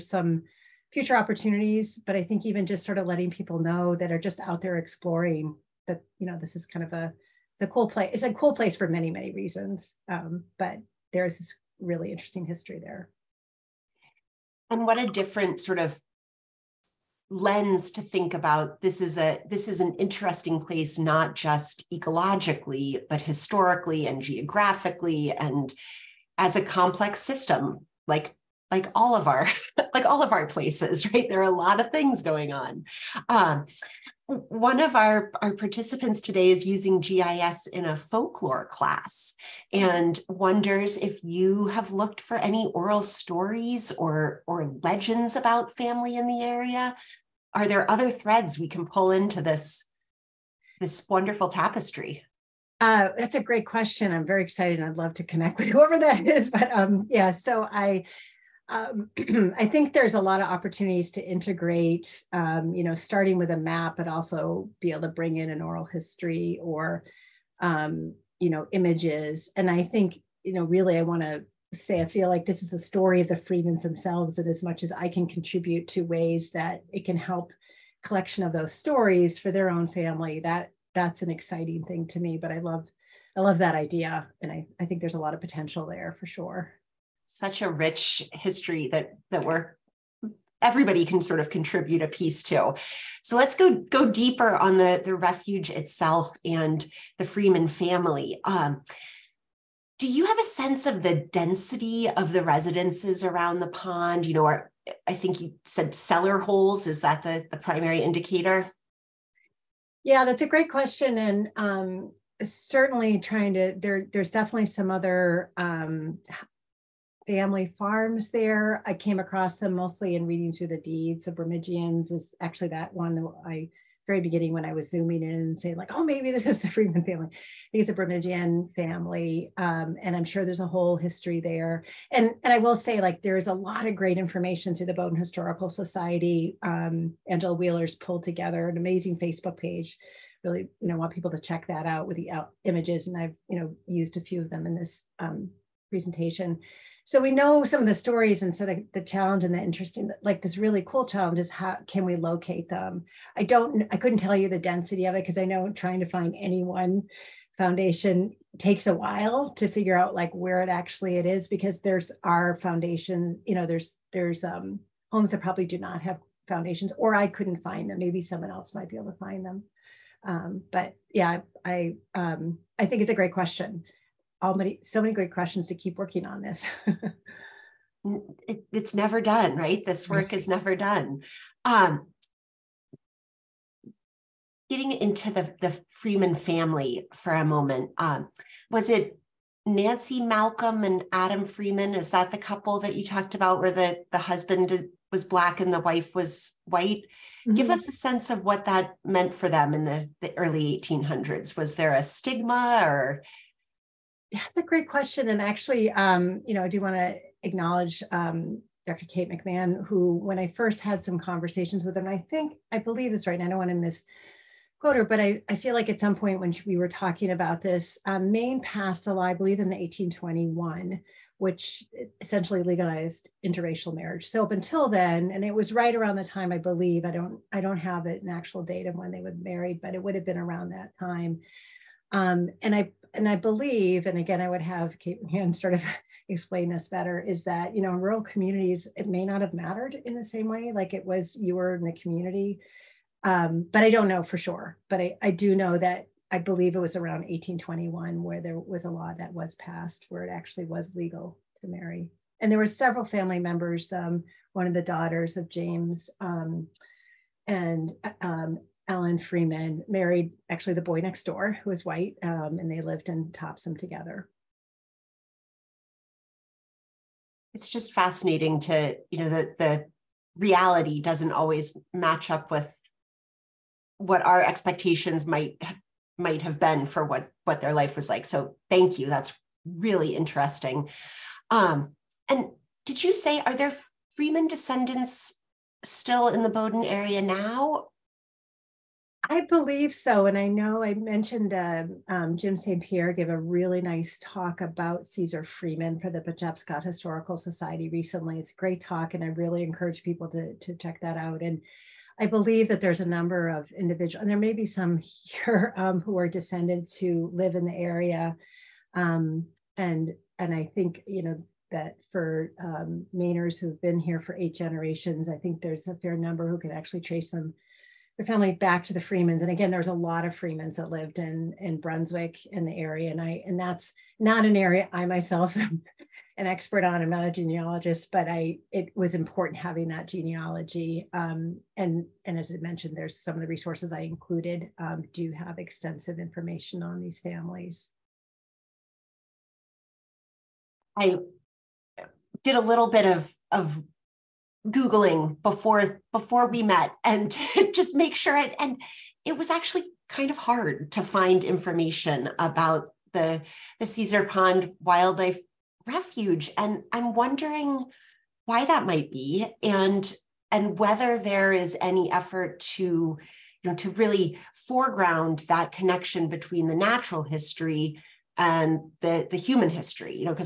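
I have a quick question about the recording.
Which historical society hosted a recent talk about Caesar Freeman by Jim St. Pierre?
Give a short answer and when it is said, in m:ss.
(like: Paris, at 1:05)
Pejepscot Historical Society, at 4:56.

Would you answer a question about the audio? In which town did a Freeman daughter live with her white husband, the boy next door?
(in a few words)
Topsham.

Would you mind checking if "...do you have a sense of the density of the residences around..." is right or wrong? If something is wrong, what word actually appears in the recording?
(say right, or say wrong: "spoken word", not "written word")
right.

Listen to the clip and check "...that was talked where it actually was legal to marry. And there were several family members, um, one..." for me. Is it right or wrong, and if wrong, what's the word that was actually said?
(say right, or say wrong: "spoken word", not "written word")
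wrong: "passed", not "talked".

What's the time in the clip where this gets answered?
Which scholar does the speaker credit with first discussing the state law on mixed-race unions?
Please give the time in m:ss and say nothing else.
3:28.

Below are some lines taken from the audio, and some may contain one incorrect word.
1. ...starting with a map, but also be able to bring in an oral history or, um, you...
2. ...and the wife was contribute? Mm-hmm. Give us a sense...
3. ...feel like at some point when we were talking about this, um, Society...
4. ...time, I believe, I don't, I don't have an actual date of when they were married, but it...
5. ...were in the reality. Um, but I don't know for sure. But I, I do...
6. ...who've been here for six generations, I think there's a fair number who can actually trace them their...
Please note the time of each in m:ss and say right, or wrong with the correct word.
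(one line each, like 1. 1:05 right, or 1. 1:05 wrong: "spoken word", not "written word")
1. 1:02 right
2. 3:15 wrong: "white", not "contribute"
3. 3:35 wrong: "Maine", not "Society"
4. 3:46 right
5. 4:01 wrong: "community", not "reality"
6. 5:13 wrong: "eight", not "six".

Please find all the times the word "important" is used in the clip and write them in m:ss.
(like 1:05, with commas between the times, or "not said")
5:29.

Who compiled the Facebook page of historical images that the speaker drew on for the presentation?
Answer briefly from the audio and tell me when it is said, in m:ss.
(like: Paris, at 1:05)
Angela Wheeler, at 2:17.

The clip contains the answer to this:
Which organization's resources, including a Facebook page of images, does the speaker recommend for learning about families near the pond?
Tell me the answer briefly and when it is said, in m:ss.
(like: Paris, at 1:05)
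Bowdoin Historical Society, at 2:14.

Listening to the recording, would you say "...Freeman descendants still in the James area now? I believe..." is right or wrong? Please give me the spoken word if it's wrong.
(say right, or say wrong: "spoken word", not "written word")
wrong: "Bowdoin", not "James".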